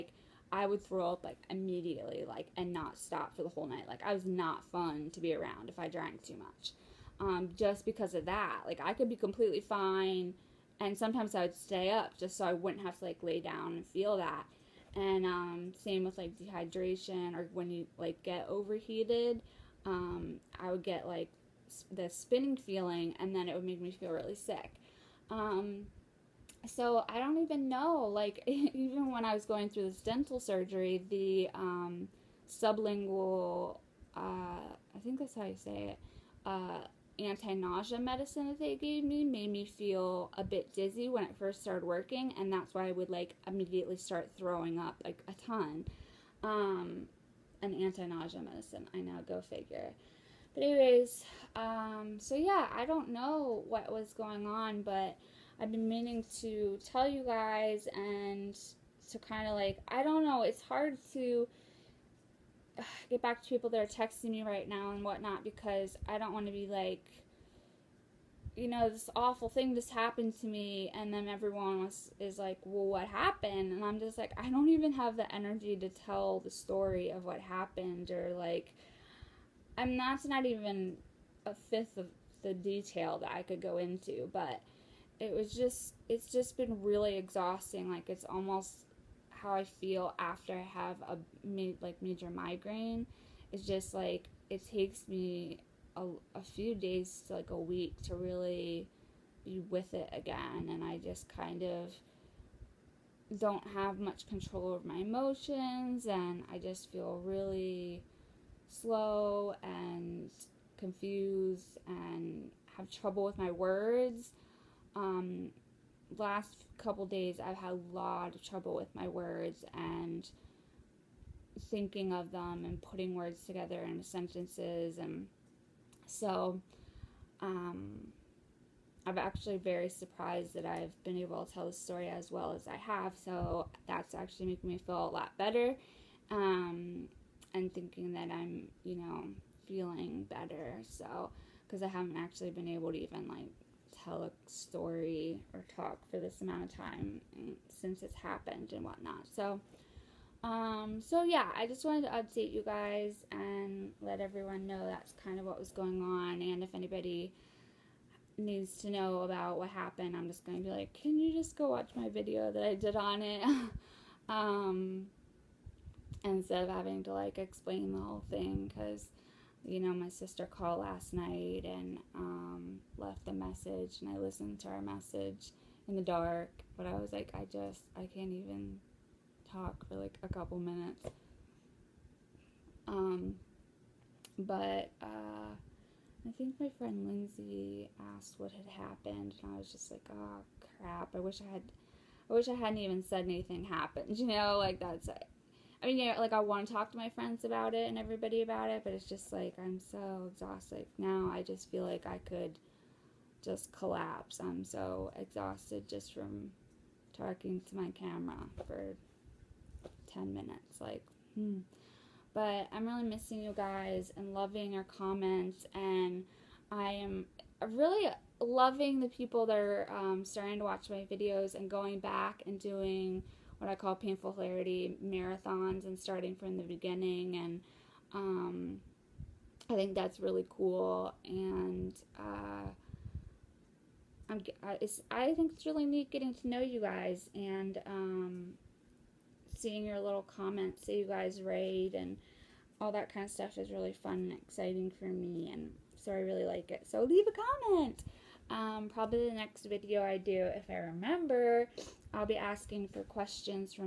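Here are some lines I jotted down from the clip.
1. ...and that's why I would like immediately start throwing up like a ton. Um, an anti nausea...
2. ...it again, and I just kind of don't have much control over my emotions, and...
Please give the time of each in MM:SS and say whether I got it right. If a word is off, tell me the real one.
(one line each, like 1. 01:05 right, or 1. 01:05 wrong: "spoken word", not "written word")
1. 00:42 right
2. 01:39 right.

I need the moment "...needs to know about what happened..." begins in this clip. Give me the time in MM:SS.
02:38.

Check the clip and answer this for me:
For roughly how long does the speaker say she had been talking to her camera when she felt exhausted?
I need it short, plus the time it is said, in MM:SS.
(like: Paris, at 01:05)
10 minutes, at 03:30.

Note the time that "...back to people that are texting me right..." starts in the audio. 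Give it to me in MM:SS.
01:03.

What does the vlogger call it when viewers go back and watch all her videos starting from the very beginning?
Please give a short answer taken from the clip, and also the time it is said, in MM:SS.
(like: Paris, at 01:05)
Painful hilarity marathons, at 03:43.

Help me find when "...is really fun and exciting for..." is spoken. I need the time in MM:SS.
04:03.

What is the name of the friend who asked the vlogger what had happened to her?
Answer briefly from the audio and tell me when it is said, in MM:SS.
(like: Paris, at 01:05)
Lindsay, at 03:07.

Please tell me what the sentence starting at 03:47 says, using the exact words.
And um, I think that's really cool.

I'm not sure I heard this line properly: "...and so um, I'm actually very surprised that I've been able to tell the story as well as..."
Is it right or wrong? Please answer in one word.
right.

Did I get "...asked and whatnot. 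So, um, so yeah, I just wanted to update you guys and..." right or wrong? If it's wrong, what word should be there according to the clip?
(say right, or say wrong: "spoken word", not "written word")
wrong: "happened", not "asked".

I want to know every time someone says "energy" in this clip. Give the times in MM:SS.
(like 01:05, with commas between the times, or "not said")
01:15.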